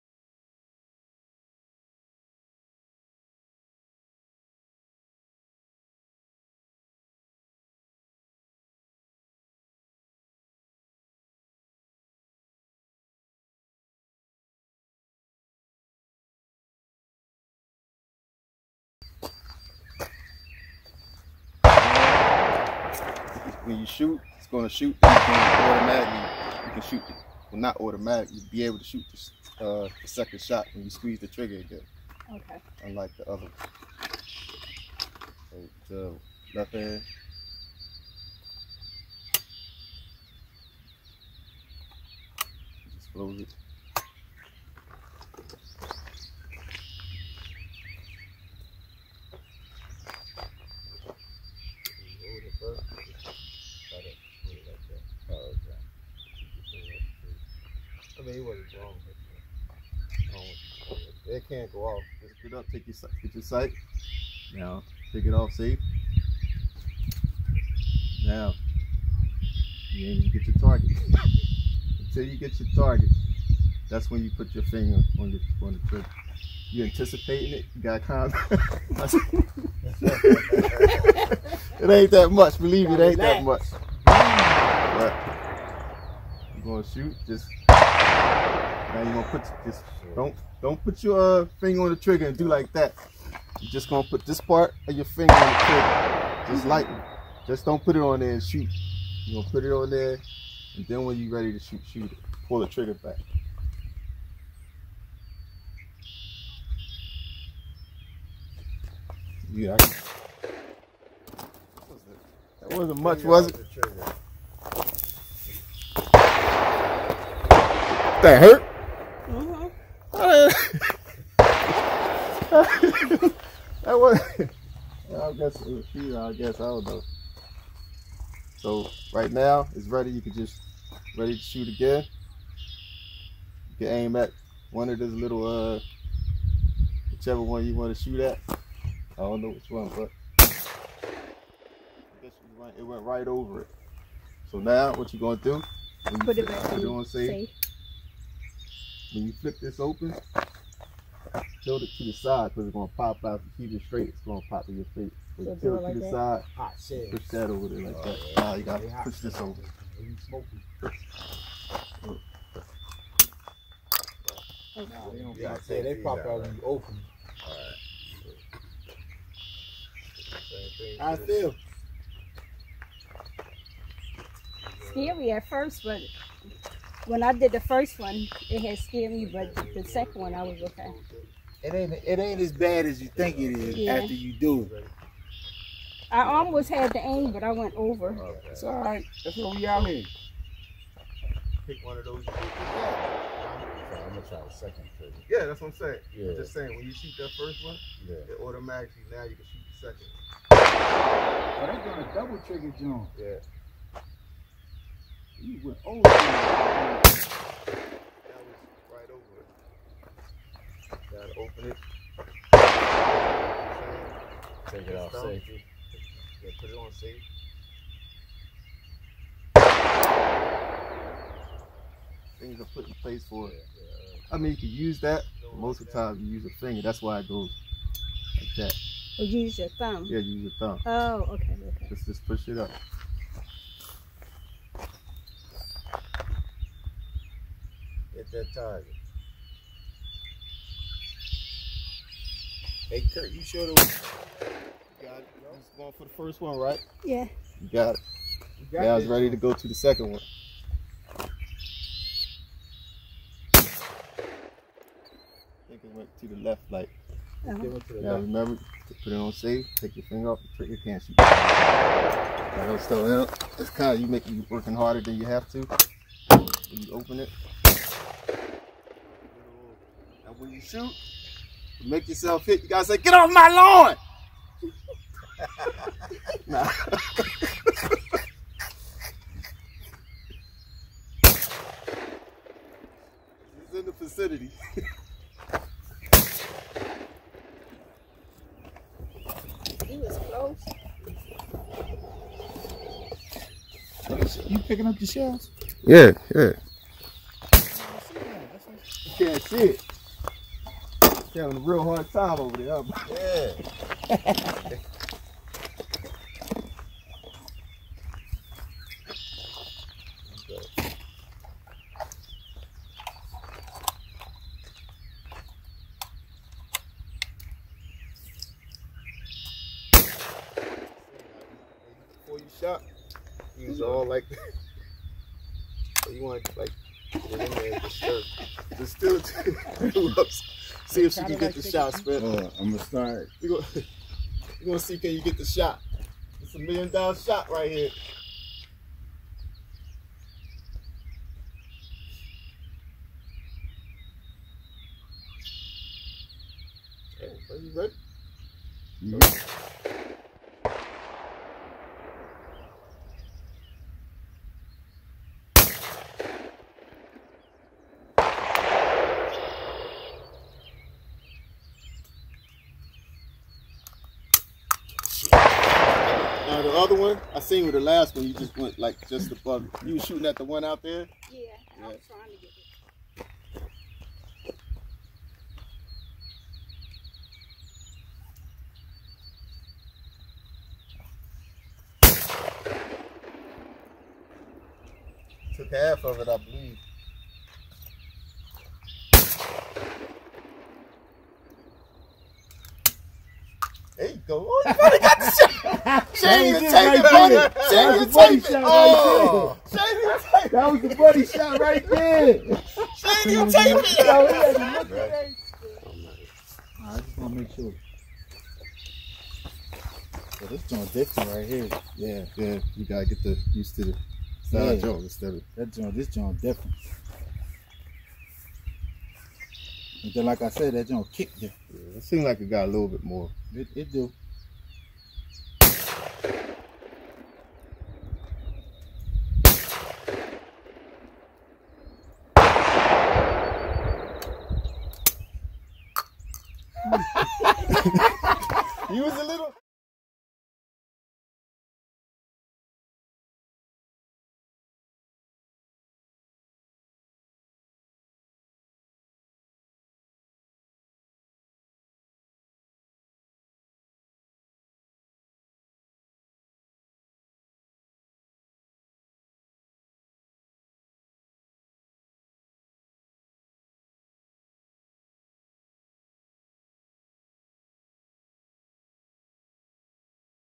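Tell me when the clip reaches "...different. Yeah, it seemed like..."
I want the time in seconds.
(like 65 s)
421 s.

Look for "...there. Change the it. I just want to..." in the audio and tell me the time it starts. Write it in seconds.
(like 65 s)
401 s.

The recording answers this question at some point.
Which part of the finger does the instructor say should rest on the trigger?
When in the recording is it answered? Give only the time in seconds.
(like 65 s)
94 s.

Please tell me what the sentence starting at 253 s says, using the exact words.
I think it went to the left, like.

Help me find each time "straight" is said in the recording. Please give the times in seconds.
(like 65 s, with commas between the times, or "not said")
153 s.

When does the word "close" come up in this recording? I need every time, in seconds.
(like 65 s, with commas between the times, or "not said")
43 s, 290 s.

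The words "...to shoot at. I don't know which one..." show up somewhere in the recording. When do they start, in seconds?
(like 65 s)
137 s.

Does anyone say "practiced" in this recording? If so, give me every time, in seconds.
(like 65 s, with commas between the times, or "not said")
not said.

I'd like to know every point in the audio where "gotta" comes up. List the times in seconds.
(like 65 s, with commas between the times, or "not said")
158 s, 211 s, 272 s, 412 s.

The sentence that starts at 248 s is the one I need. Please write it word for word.
You got yeah, I was ready to go to the second one.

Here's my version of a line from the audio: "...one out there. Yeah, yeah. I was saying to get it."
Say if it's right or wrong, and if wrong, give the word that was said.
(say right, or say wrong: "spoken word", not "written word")
wrong: "trying", not "saying".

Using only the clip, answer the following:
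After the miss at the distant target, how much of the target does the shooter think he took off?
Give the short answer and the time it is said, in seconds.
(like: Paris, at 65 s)
half, at 385 s.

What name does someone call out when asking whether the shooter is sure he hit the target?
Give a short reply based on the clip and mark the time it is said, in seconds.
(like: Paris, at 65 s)
Kurt, at 243 s.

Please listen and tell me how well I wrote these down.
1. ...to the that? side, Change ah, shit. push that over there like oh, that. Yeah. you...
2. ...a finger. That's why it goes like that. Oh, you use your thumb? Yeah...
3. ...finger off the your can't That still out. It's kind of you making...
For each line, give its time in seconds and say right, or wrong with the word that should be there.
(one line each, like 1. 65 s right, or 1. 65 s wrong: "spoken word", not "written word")
1. 155 s wrong: "Hot", not "Change"
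2. 226 s right
3. 260 s right.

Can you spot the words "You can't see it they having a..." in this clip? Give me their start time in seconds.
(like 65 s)
299 s.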